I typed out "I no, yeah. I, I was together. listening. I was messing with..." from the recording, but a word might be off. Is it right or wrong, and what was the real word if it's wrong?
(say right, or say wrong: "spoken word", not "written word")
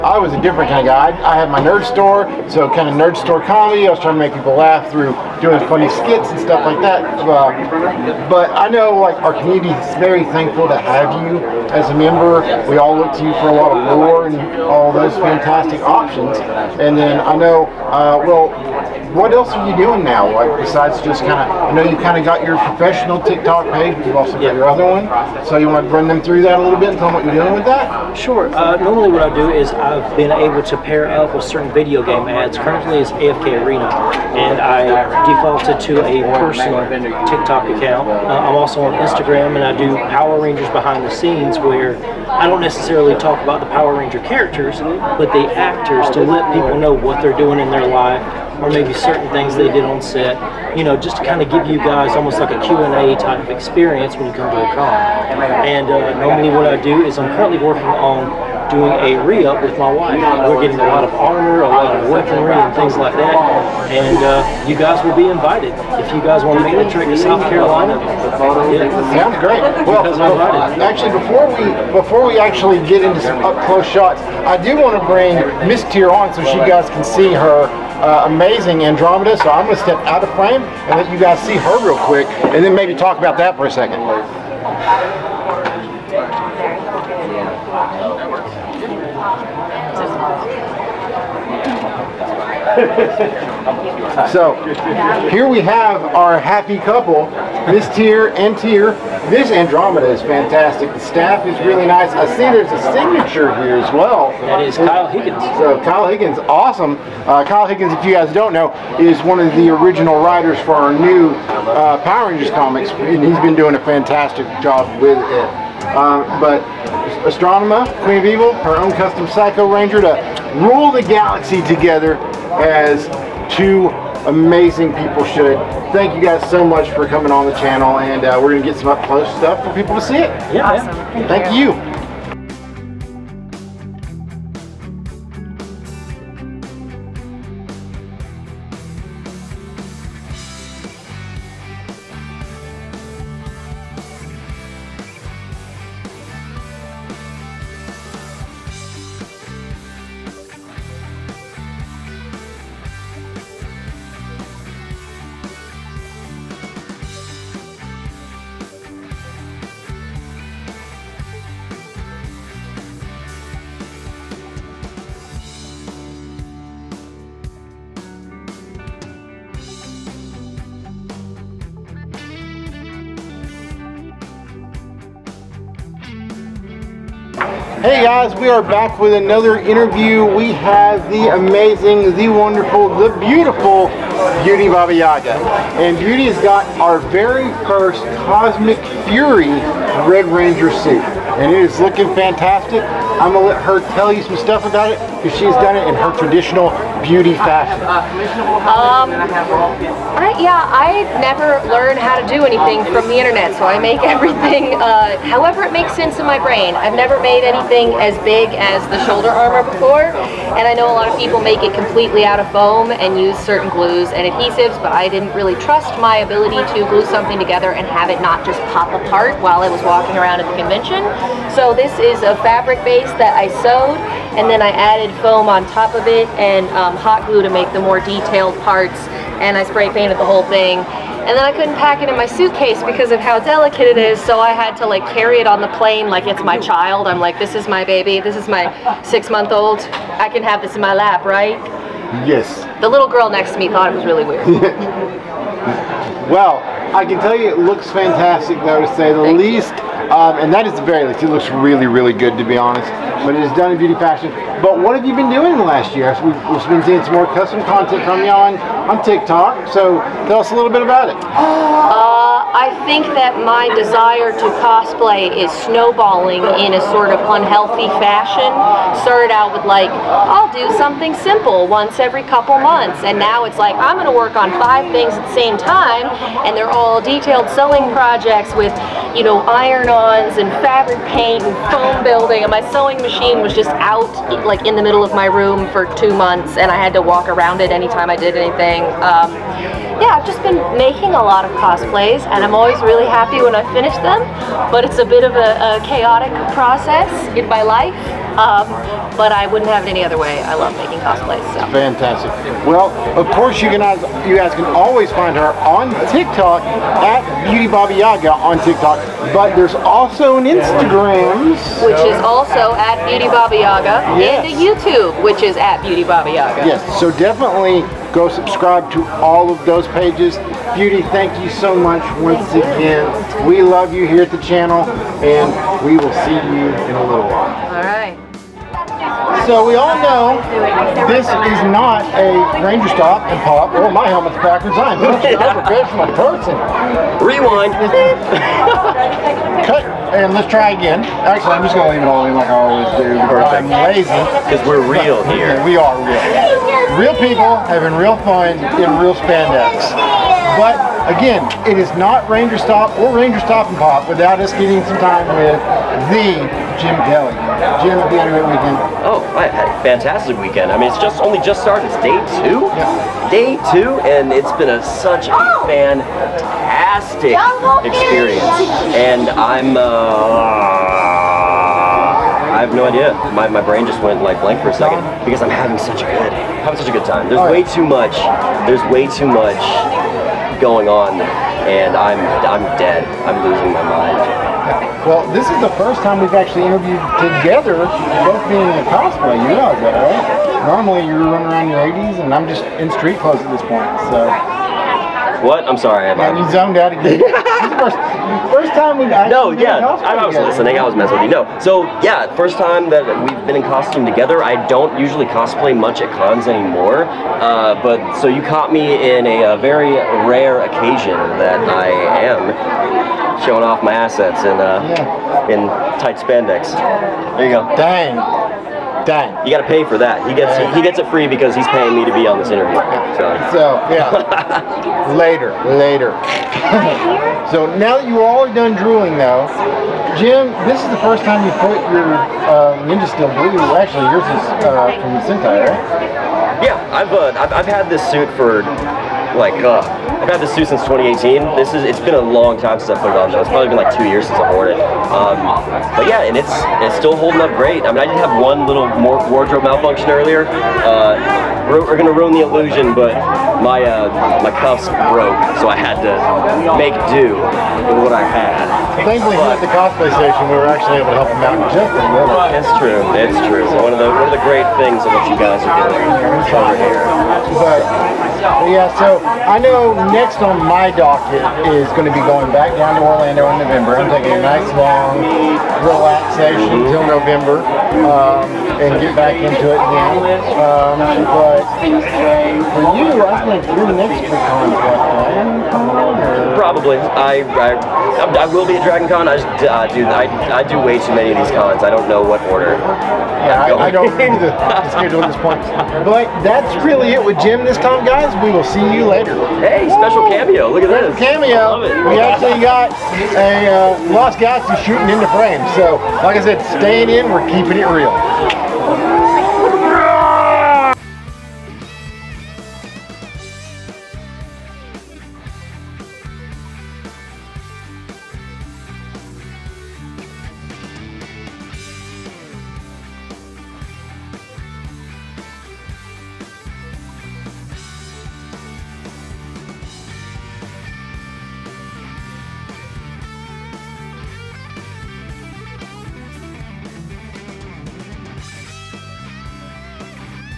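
right.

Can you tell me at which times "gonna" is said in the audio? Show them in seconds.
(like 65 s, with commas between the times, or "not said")
193 s, 451 s.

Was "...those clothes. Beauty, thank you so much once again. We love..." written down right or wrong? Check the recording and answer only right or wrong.
wrong.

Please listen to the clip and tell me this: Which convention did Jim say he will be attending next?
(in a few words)
Dragon Con.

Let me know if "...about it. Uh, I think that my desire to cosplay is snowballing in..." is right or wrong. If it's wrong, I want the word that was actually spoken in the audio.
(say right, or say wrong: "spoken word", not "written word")
right.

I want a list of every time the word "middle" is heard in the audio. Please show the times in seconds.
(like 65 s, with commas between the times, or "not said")
284 s.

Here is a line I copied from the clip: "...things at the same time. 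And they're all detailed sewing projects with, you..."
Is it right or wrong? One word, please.
right.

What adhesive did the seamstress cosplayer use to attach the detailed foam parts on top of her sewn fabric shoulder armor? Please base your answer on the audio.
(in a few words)
hot glue.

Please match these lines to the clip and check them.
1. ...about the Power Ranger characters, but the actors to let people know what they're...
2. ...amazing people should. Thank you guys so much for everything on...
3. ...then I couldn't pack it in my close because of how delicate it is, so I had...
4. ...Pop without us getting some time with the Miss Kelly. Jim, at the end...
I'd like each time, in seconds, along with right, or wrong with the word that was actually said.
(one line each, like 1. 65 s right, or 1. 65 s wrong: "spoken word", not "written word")
1. 43 s right
2. 124 s wrong: "coming", not "everything"
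3. 231 s wrong: "suitcase", not "close"
4. 353 s wrong: "Jim", not "Miss".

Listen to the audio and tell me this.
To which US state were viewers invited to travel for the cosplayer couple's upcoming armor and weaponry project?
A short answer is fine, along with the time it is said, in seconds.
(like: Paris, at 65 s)
South Carolina, at 67 s.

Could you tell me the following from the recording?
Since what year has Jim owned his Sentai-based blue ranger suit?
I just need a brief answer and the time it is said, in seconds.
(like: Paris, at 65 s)
2018, at 440 s.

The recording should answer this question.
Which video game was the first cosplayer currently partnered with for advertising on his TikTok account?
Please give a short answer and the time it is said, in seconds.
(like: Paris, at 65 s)
AFK Arena, at 33 s.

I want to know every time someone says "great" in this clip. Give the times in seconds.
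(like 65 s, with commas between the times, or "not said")
69 s, 447 s, 464 s.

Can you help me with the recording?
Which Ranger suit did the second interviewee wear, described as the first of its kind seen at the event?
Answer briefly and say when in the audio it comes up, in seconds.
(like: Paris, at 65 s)
Cosmic Fury Red Ranger, at 188 s.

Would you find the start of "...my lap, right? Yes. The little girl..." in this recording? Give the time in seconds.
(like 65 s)
240 s.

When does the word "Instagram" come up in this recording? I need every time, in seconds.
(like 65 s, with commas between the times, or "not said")
38 s, 310 s.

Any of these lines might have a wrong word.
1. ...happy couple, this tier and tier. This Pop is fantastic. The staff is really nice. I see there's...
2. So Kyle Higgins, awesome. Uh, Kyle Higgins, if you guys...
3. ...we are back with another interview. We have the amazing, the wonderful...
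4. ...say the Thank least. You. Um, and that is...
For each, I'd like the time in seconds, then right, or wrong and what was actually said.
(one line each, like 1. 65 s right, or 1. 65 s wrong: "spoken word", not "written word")
1. 96 s wrong: "Andromeda", not "Pop"
2. 105 s right
3. 178 s right
4. 248 s right.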